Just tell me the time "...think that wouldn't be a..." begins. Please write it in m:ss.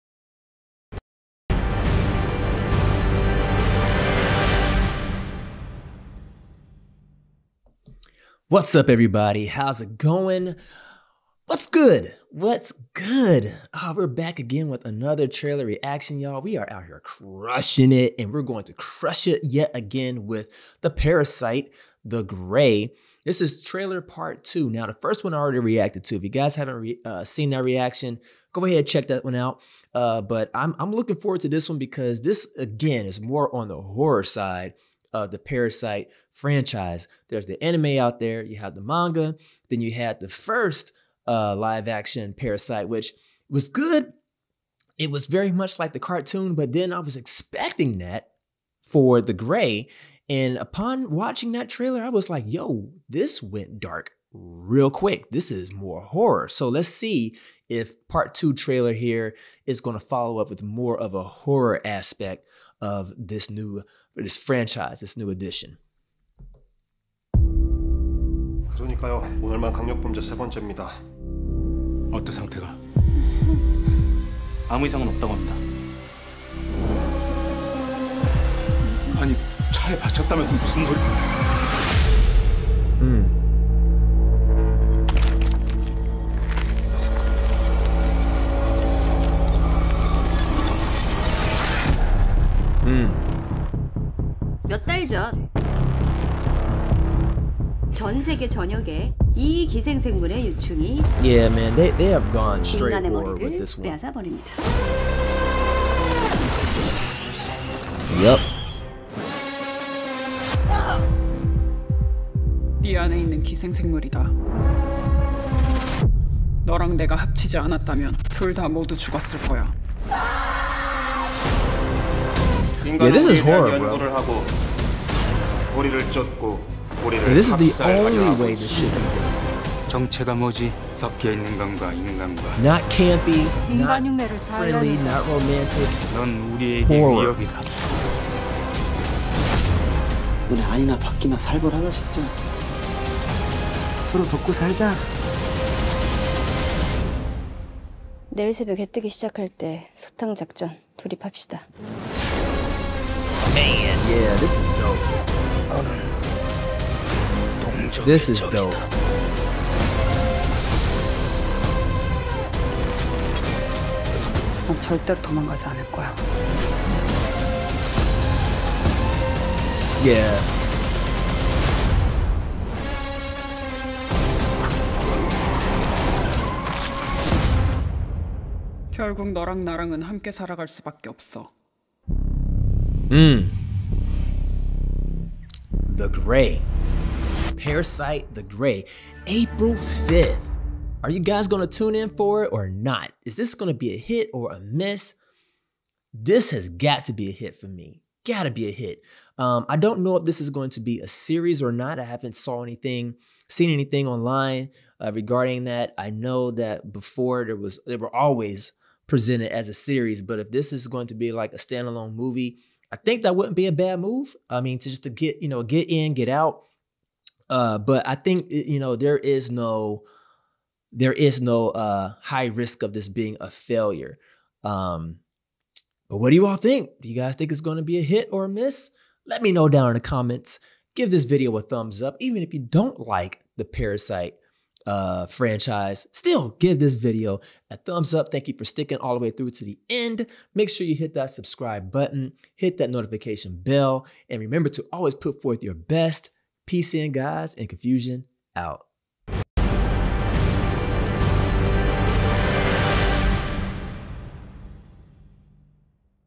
3:32.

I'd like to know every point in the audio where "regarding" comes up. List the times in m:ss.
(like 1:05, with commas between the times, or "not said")
3:25.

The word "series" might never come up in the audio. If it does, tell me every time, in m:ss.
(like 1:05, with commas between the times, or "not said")
3:21, 3:29.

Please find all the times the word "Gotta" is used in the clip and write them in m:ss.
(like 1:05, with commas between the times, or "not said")
3:18.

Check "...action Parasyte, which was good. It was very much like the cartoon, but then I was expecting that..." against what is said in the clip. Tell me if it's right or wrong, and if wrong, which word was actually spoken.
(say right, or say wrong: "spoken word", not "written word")
right.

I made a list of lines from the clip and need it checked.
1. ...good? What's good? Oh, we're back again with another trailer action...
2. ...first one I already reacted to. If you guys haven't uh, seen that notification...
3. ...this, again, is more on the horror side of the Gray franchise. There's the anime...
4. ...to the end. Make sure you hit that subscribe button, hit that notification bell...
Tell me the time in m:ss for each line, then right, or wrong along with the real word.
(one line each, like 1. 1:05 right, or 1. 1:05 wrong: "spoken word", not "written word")
1. 0:11 wrong: "reaction", not "action"
2. 0:24 wrong: "reaction", not "notification"
3. 0:32 wrong: "Parasyte", not "Gray"
4. 3:59 right.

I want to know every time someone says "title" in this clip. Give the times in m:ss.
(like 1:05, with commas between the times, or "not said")
not said.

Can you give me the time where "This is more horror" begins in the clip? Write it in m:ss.
0:55.